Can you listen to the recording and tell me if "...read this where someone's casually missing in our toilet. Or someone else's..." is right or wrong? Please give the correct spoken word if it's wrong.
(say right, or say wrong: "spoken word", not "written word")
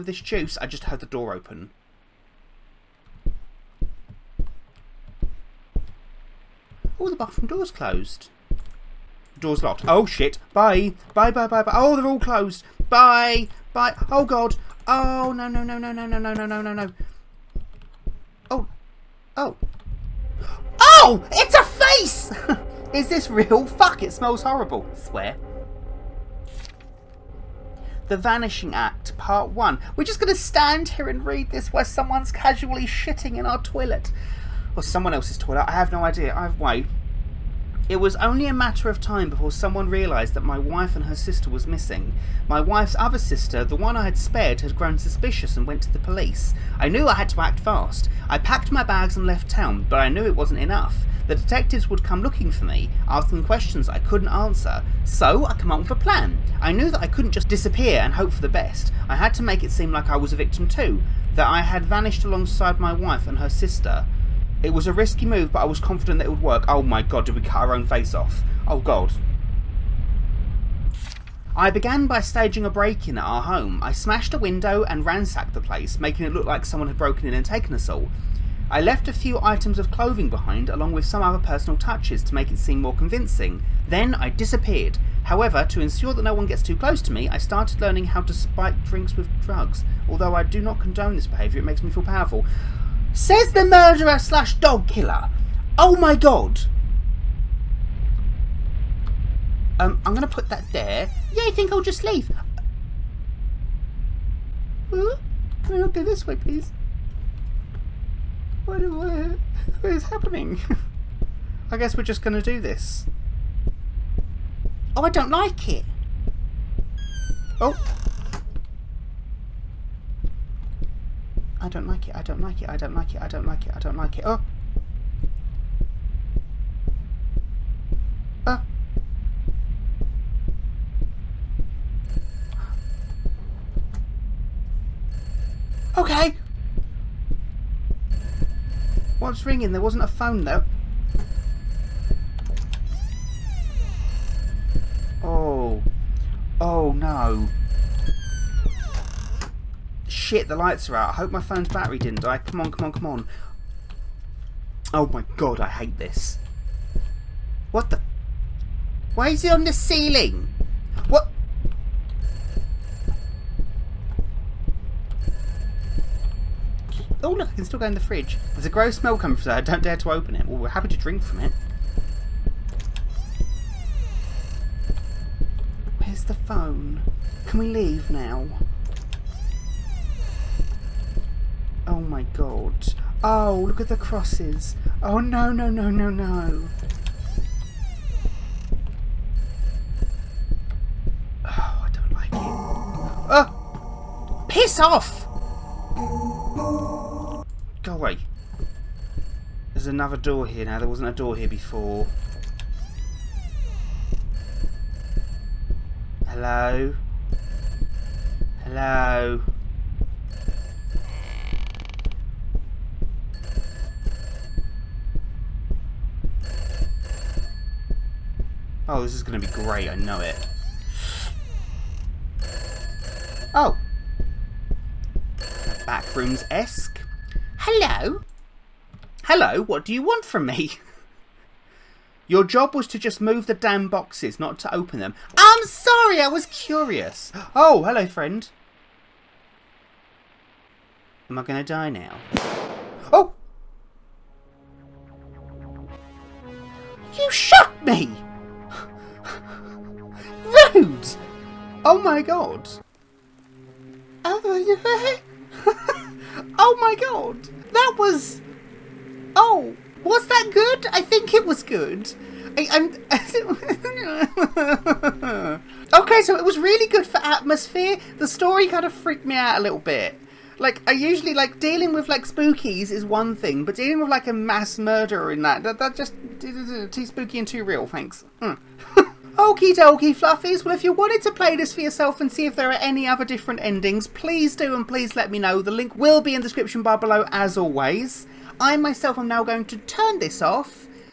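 wrong: "shitting", not "missing".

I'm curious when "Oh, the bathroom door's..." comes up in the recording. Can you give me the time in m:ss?
0:06.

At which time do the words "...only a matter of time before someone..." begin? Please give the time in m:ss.
0:38.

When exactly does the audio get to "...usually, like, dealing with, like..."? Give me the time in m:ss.
4:30.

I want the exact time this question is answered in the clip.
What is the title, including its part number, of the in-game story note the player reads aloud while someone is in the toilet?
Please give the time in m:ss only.
0:28.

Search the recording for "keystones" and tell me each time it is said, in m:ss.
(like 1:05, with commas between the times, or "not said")
not said.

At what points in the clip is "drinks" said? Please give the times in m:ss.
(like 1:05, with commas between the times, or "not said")
1:28, 2:50.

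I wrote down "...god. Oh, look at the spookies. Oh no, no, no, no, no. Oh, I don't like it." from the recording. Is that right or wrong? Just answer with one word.
wrong.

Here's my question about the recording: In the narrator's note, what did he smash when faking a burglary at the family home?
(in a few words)
A window.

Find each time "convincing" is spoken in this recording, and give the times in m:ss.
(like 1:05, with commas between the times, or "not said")
1:22.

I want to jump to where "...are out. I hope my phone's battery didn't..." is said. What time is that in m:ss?
2:30.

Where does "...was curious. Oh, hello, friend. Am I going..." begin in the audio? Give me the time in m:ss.
3:56.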